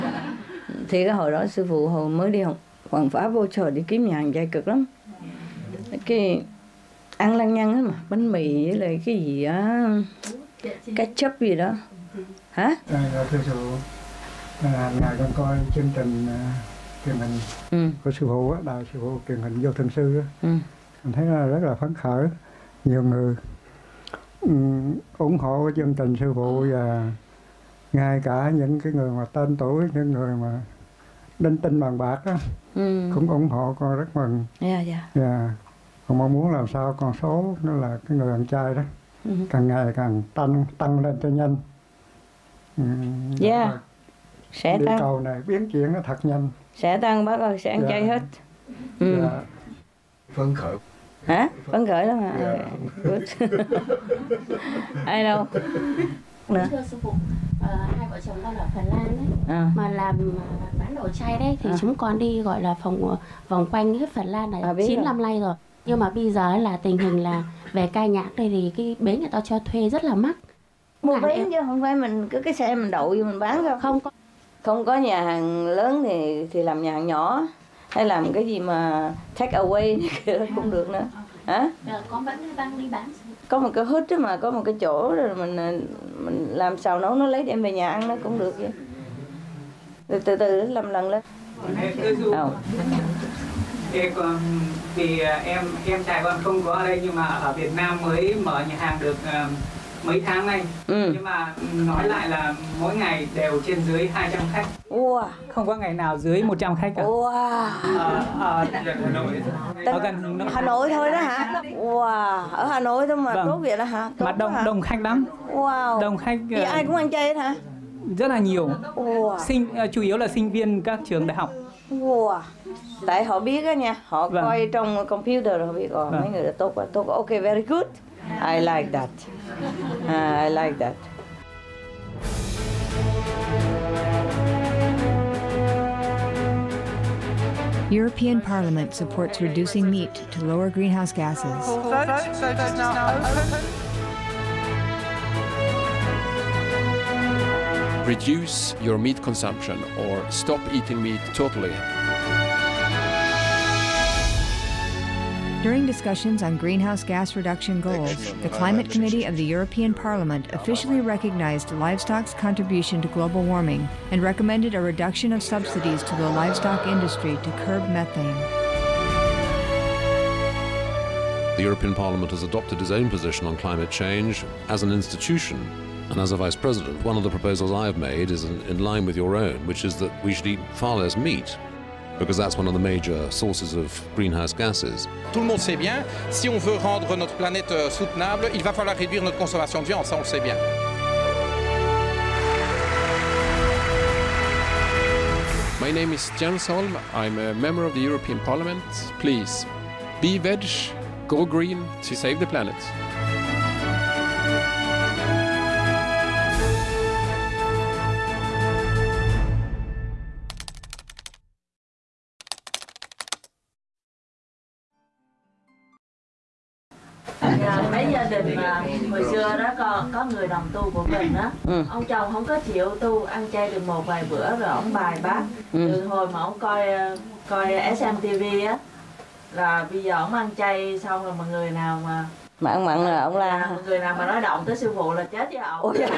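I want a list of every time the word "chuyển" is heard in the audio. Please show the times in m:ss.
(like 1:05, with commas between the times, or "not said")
0:45.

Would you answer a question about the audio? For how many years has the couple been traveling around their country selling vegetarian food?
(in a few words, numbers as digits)
9.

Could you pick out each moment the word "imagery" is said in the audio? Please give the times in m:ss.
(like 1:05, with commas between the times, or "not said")
not said.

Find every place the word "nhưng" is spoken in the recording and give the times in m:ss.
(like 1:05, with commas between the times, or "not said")
1:05, 1:37, 1:41.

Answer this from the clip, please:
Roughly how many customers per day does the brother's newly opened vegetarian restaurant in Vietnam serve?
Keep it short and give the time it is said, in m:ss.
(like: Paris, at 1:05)
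200, at 1:44.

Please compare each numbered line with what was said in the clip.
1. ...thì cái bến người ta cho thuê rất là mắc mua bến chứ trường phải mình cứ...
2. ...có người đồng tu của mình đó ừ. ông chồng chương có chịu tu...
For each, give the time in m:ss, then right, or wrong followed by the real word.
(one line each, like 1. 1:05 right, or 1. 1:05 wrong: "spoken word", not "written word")
1. 1:08 wrong: "không", not "trường"
2. 3:40 wrong: "không", not "chương".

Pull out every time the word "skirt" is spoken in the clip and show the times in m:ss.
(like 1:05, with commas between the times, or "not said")
not said.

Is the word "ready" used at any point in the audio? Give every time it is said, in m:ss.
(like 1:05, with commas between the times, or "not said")
not said.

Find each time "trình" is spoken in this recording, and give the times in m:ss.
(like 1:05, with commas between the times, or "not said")
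0:15, 0:25.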